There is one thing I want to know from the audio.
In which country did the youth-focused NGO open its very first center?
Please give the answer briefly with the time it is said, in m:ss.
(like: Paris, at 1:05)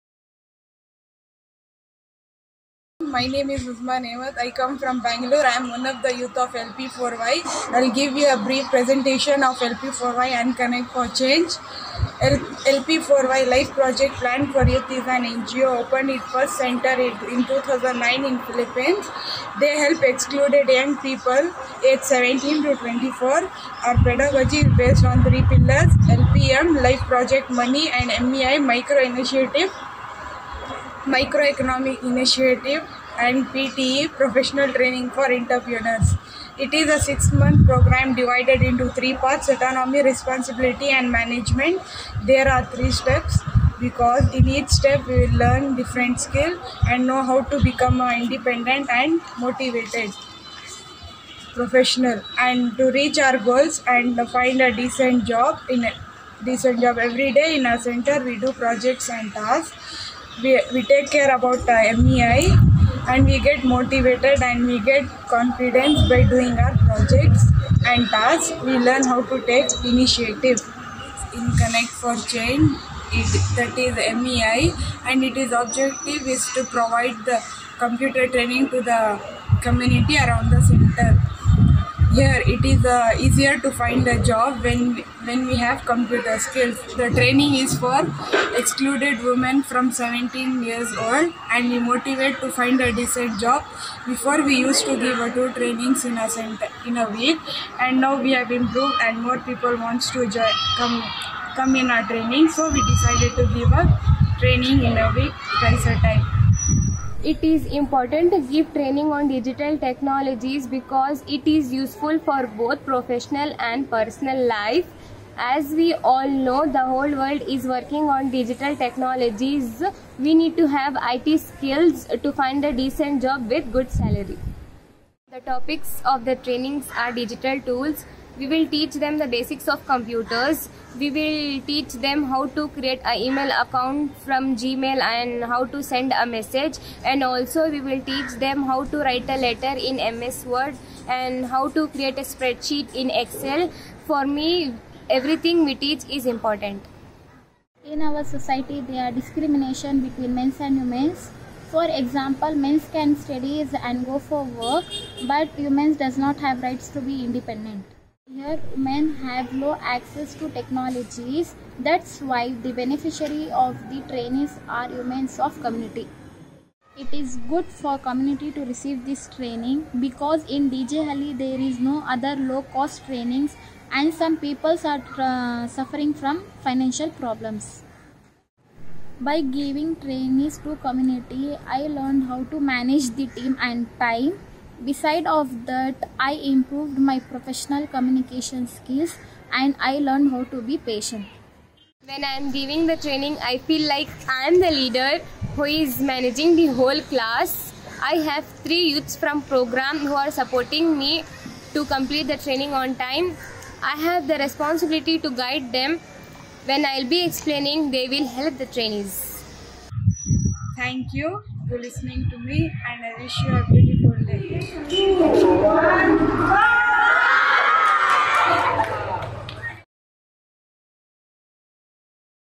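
Philippines, at 0:18.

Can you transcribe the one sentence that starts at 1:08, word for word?
We learn how to take initiative.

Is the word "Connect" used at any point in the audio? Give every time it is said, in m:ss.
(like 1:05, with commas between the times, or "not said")
0:10, 1:11.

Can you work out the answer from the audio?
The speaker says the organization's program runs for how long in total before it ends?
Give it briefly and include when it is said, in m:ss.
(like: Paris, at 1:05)
6 months, at 0:36.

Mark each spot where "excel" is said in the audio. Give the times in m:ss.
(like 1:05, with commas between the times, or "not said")
2:23.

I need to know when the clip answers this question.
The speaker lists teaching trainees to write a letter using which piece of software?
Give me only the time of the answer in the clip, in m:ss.
2:20.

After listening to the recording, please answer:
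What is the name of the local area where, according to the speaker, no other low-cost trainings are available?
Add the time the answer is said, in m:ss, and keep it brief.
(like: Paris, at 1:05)
DJ Halli, at 2:50.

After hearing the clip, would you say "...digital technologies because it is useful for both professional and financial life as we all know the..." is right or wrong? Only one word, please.
wrong.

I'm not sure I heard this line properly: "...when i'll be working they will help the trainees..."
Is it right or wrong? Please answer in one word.
wrong.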